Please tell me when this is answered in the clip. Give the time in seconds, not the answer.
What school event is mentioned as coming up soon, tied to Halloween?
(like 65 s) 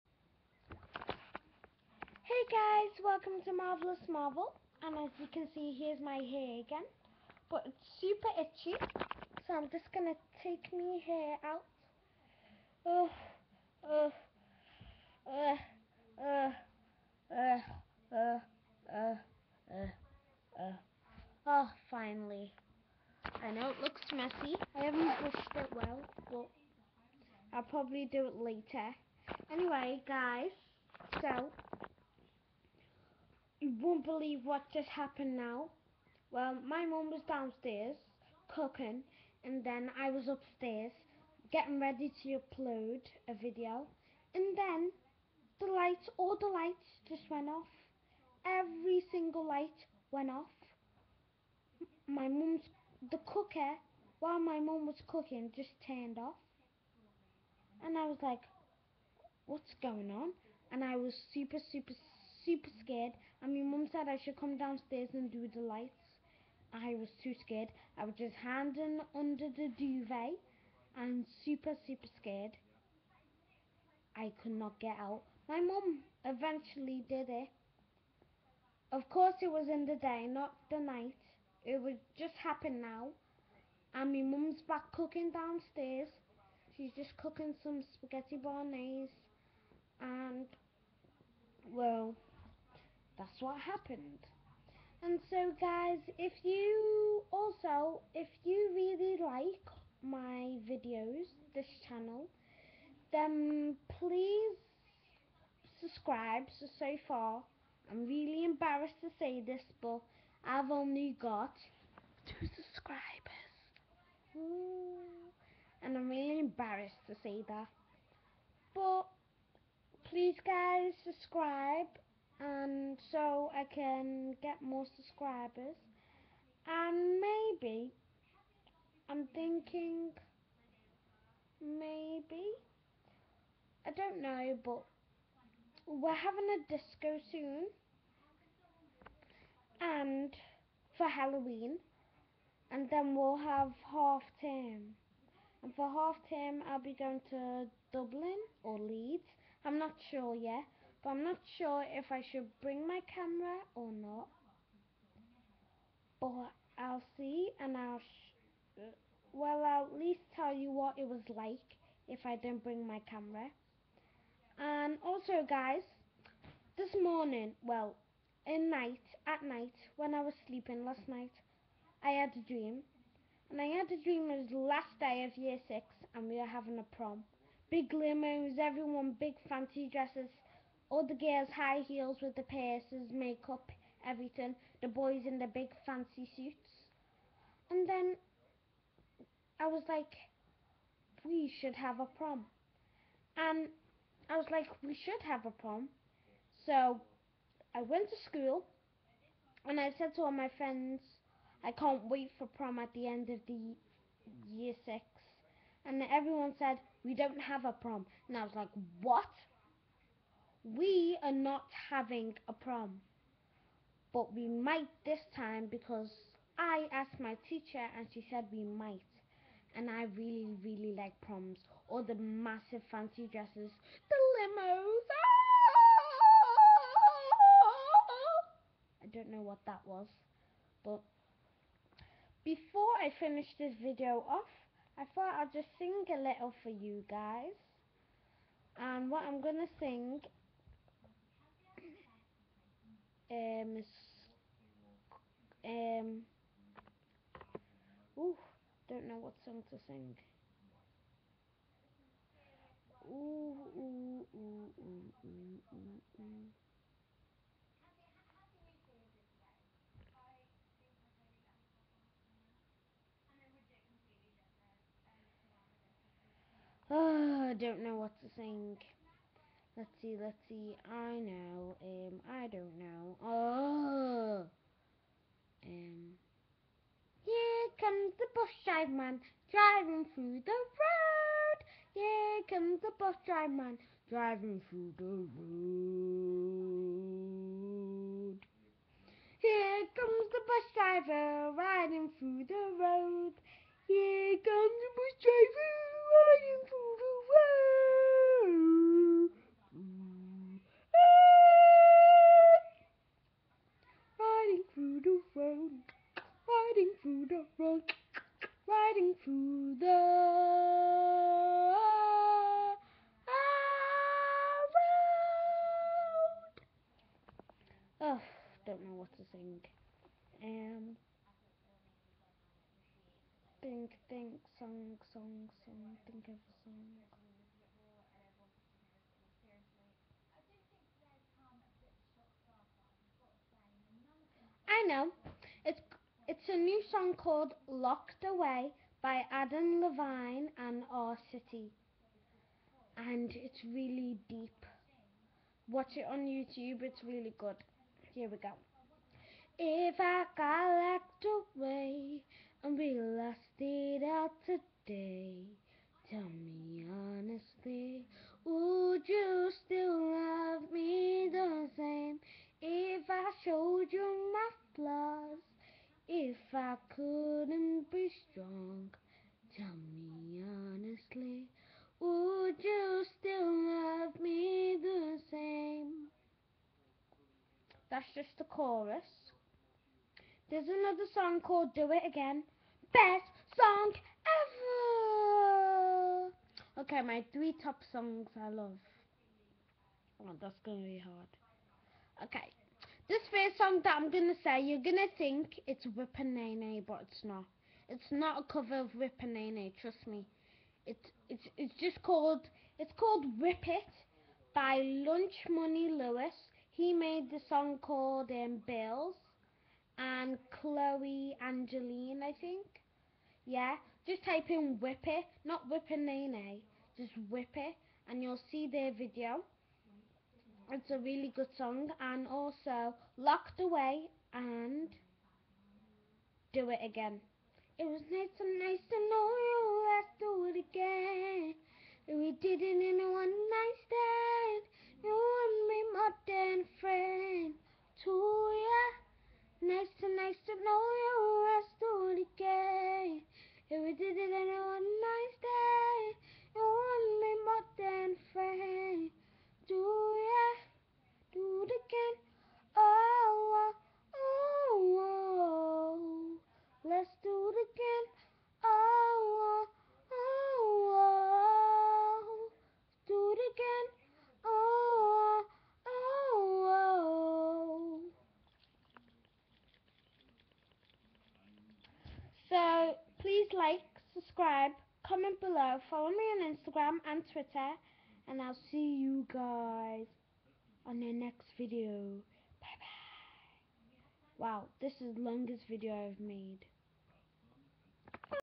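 136 s.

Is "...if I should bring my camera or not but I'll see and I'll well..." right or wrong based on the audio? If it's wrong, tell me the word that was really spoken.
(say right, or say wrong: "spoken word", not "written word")
right.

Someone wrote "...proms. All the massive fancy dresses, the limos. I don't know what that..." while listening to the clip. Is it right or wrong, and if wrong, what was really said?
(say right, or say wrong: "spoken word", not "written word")
right.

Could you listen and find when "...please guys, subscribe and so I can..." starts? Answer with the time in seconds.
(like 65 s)
120 s.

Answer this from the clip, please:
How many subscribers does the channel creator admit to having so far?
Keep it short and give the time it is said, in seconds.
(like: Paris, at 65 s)
2, at 112 s.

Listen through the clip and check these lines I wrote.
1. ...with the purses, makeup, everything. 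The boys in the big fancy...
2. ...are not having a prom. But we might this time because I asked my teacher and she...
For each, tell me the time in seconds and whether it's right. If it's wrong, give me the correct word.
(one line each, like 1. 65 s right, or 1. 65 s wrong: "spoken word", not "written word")
1. 182 s right
2. 211 s right.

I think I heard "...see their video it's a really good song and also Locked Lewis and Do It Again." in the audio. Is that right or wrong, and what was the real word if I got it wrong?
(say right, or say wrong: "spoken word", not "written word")
wrong: "Away", not "Lewis".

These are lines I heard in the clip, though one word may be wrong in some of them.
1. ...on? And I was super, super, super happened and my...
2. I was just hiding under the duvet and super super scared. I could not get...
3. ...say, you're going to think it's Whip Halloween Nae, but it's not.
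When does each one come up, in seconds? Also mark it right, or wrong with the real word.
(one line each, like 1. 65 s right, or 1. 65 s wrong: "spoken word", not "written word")
1. 60 s wrong: "scared", not "happened"
2. 67 s right
3. 394 s wrong: "Nae", not "Halloween".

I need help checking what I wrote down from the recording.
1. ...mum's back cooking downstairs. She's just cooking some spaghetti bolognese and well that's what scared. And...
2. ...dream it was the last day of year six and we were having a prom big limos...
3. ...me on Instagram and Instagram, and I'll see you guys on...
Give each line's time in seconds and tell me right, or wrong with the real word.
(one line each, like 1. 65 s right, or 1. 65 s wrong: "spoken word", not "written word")
1. 84 s wrong: "happened", not "scared"
2. 174 s right
3. 476 s wrong: "Twitter", not "Instagram".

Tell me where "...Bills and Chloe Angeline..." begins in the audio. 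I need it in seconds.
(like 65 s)
408 s.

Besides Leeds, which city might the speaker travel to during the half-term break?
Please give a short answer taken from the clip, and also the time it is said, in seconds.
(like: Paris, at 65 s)
Dublin, at 147 s.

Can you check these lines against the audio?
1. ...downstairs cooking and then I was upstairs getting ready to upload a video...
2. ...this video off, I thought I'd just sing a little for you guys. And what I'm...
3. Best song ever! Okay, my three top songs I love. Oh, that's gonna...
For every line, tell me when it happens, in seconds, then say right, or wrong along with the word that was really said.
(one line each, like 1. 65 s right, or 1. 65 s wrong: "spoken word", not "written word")
1. 37 s right
2. 233 s right
3. 382 s right.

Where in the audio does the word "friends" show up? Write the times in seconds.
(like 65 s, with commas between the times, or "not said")
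200 s, 436 s.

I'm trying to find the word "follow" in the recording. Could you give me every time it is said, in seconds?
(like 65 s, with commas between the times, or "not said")
475 s.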